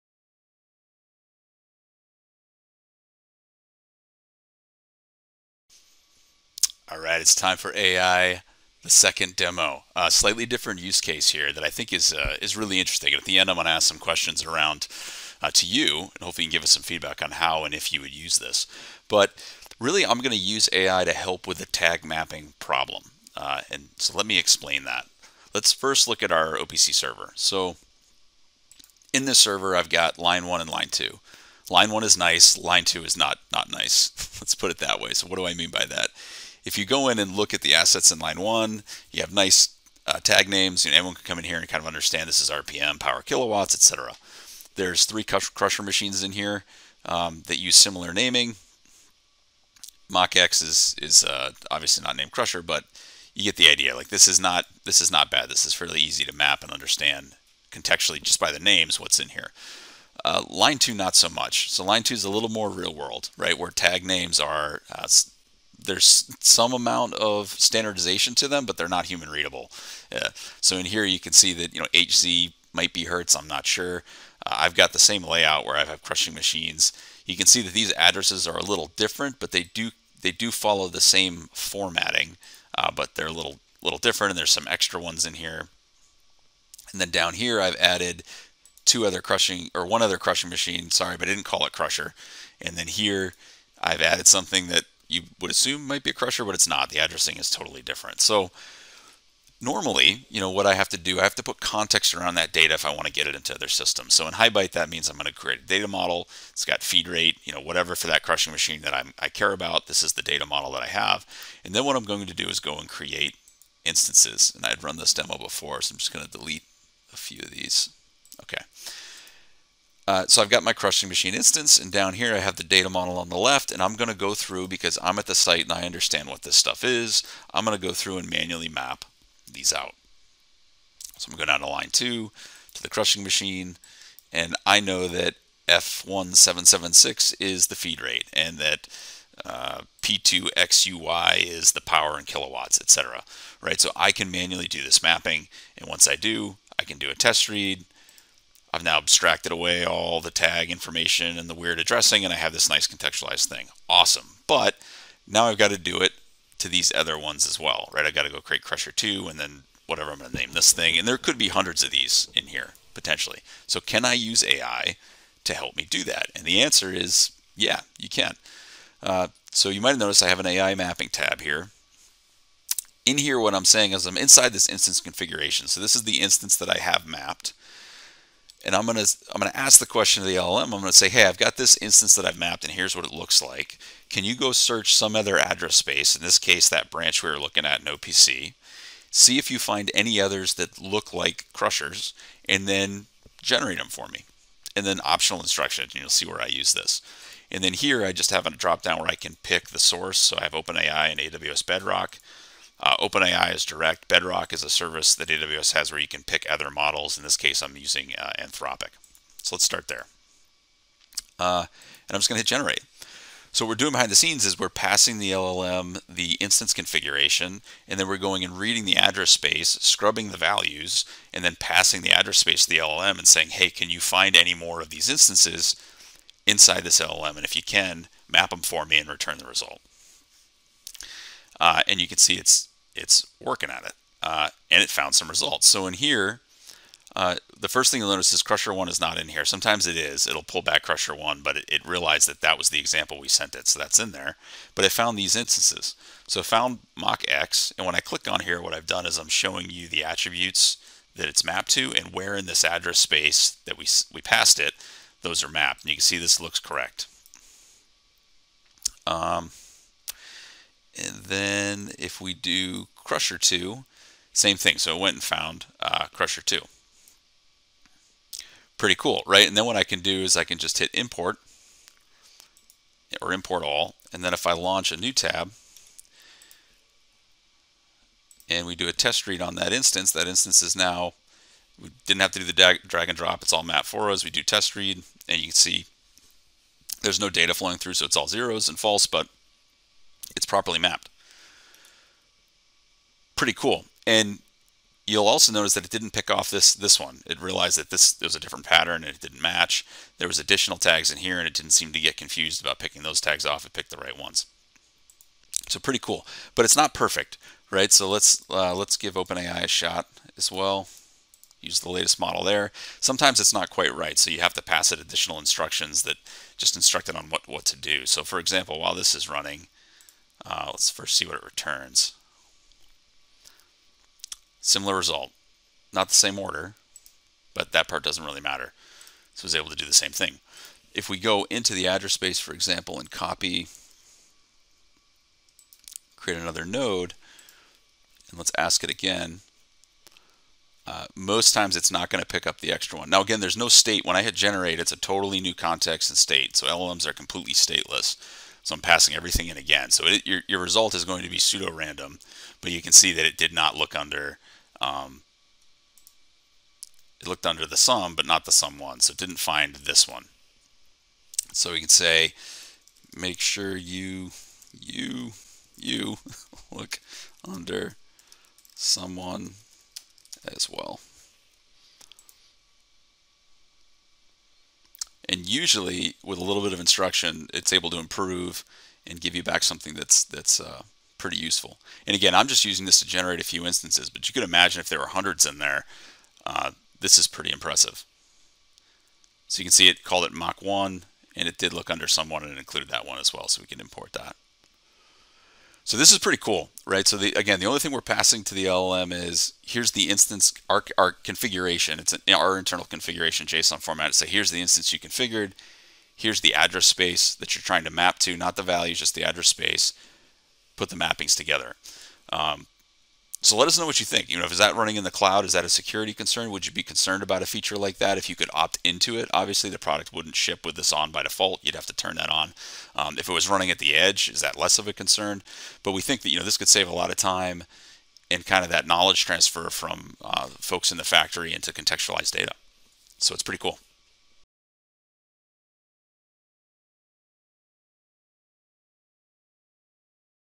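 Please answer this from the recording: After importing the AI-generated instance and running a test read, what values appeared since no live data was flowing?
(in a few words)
zeros and false.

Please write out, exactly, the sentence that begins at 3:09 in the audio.
See if you find any others that look like crushers, and then generate them for me.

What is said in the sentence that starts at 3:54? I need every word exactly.
Uh, and it found some results.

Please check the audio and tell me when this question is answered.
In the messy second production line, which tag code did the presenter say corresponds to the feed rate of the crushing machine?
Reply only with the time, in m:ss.
2:15.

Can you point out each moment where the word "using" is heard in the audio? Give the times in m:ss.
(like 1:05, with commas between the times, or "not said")
3:27, 6:22.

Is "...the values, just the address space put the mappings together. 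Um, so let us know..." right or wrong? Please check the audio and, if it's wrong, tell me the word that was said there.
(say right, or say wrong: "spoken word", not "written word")
right.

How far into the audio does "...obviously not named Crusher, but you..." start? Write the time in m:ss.
0:51.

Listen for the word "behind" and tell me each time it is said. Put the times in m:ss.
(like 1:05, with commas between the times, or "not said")
3:33.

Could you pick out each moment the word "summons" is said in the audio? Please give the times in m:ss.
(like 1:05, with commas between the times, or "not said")
not said.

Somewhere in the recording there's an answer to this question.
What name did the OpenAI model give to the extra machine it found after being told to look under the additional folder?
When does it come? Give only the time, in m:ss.
6:30.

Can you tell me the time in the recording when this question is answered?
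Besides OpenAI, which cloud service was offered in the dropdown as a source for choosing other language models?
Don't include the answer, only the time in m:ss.
3:21.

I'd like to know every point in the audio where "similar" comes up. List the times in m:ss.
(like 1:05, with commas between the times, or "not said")
0:47, 5:24.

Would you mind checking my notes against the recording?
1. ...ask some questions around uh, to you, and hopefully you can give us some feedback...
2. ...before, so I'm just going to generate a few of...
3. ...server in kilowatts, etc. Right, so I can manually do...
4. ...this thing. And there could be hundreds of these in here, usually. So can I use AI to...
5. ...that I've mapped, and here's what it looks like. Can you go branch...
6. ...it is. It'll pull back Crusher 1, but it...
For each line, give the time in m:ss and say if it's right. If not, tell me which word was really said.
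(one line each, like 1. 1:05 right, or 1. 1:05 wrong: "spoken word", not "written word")
1. 0:13 right
2. 1:55 wrong: "delete", not "generate"
3. 2:21 wrong: "power", not "server"
4. 2:40 wrong: "potentially", not "usually"
5. 3:02 wrong: "search", not "branch"
6. 3:59 right.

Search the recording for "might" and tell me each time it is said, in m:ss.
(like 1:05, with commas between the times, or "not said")
1:12, 1:35, 2:49.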